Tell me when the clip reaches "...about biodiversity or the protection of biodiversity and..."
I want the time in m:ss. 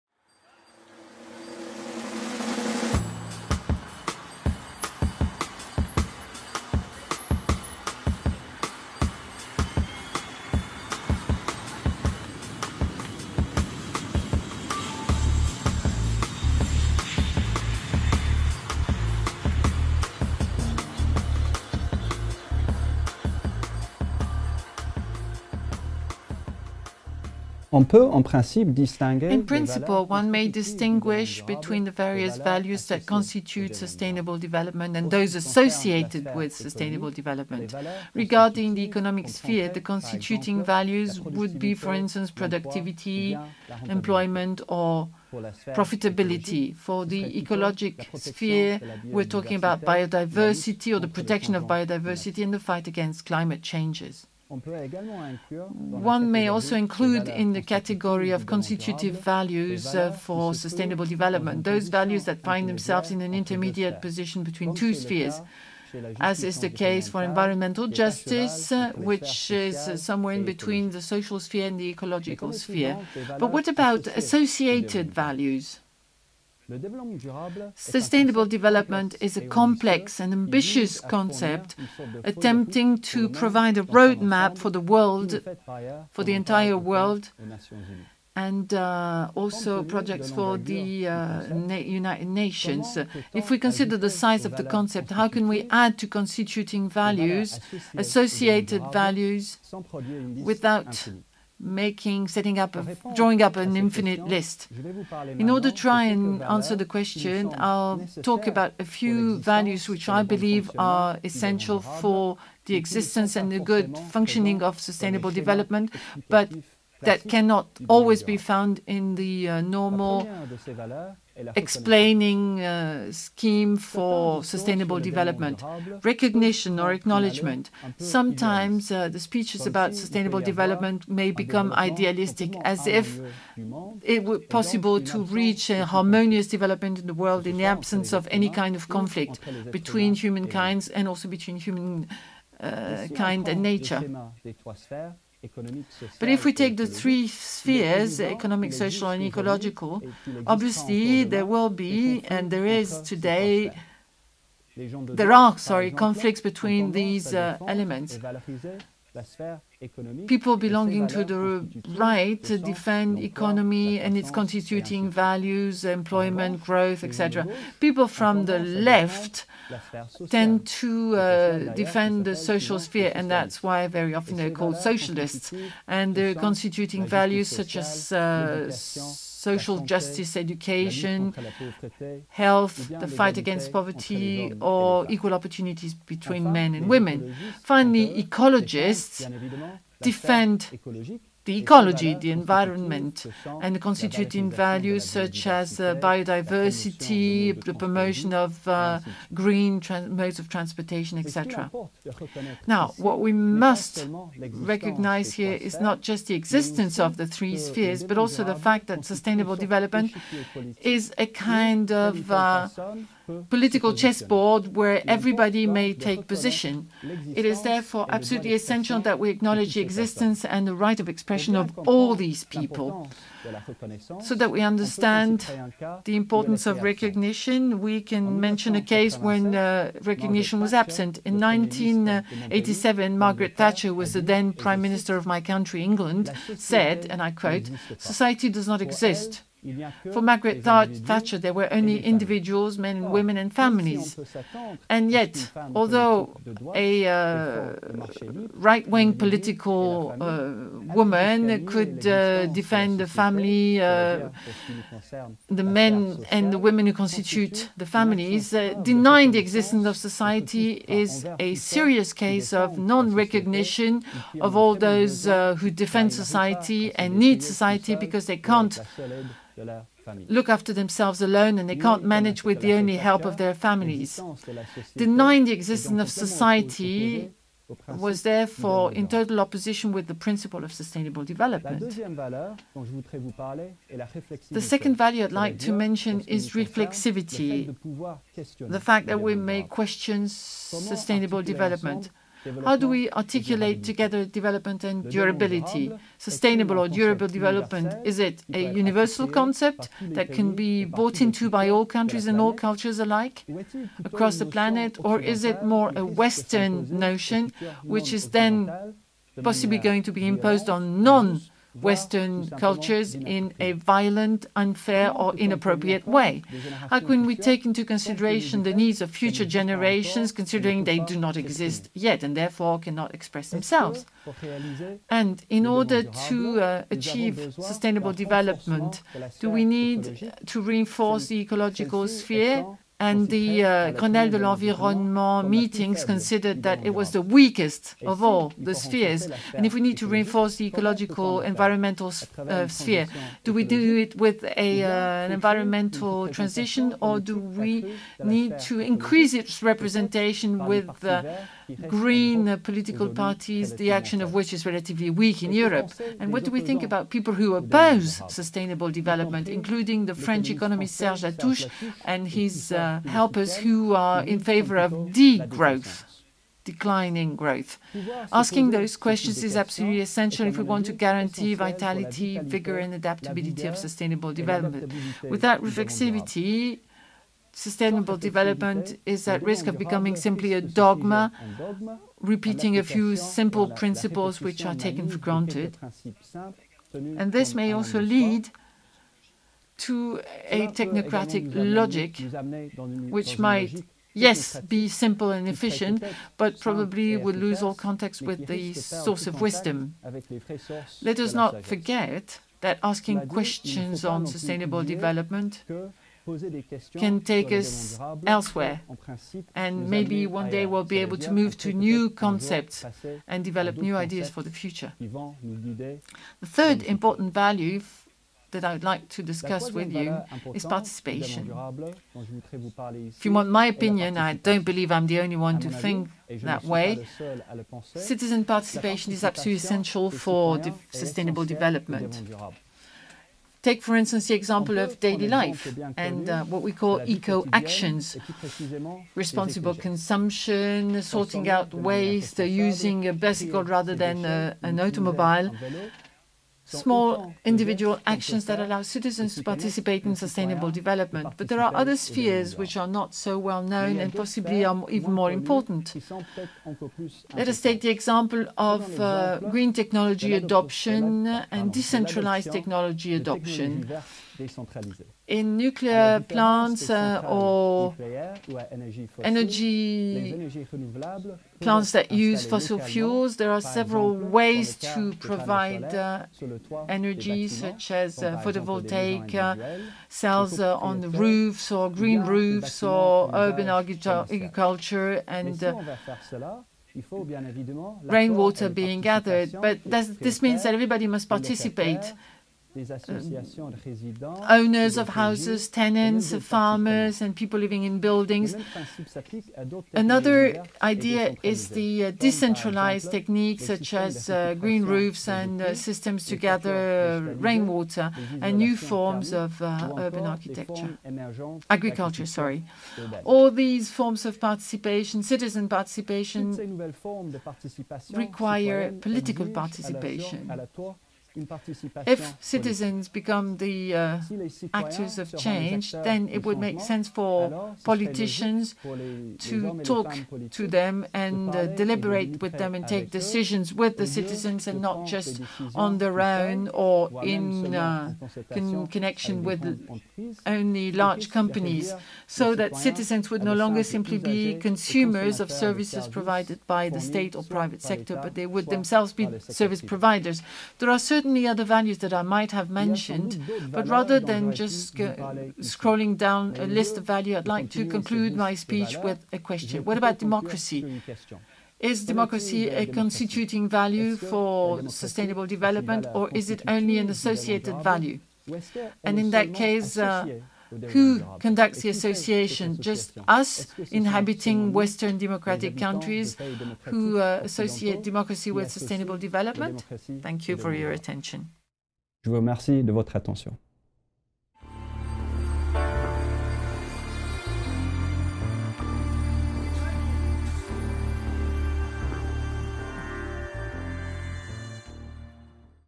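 0:49.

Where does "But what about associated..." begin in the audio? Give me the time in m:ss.
1:13.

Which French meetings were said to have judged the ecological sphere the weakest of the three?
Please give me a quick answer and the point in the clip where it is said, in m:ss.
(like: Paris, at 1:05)
Grenelle de l'Environnement, at 5:33.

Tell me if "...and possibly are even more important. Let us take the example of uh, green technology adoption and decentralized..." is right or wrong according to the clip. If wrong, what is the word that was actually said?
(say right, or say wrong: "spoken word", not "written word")
right.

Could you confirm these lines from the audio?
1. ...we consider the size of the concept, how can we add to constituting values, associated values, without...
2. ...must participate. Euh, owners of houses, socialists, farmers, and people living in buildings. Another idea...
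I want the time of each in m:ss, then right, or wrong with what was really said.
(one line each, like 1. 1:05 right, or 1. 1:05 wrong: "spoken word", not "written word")
1. 1:33 right
2. 8:11 wrong: "tenants", not "socialists".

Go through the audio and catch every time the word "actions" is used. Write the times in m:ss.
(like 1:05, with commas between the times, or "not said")
5:53, 7:17, 7:28.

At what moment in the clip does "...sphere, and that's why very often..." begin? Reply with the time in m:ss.
2:52.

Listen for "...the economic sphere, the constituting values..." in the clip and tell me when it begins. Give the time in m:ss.
0:38.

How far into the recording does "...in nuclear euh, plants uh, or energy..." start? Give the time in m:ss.
7:45.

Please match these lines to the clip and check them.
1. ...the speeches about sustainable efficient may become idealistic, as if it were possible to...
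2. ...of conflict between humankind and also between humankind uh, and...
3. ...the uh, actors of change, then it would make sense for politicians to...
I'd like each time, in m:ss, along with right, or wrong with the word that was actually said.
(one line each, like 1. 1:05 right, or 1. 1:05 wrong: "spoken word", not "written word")
1. 2:09 wrong: "development", not "efficient"
2. 2:18 right
3. 8:43 right.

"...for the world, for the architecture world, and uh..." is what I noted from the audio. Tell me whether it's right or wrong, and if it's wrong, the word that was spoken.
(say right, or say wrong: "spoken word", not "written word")
wrong: "entire", not "architecture".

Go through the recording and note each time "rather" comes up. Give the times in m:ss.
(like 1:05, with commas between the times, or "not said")
7:23, 9:13.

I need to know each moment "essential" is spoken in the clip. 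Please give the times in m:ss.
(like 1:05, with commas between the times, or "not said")
1:51, 3:38, 6:10, 7:09.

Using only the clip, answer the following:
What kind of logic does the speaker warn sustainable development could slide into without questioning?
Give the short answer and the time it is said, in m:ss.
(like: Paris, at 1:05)
technocratic logic, at 6:30.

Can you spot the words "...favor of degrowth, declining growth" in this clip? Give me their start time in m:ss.
6:04.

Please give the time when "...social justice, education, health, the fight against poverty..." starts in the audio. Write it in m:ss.
2:59.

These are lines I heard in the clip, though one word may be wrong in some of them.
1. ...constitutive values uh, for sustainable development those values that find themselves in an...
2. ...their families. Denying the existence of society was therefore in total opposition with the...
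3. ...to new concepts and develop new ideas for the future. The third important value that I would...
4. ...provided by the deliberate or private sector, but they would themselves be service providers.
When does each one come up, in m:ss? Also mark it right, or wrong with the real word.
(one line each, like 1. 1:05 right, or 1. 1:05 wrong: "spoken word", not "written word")
1. 0:58 right
2. 4:33 right
3. 6:51 right
4. 9:06 wrong: "state", not "deliberate".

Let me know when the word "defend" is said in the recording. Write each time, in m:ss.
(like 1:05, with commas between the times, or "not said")
2:42, 2:51, 3:10, 4:12, 4:25.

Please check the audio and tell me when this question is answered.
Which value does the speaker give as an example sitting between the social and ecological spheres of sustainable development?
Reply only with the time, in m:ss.
1:07.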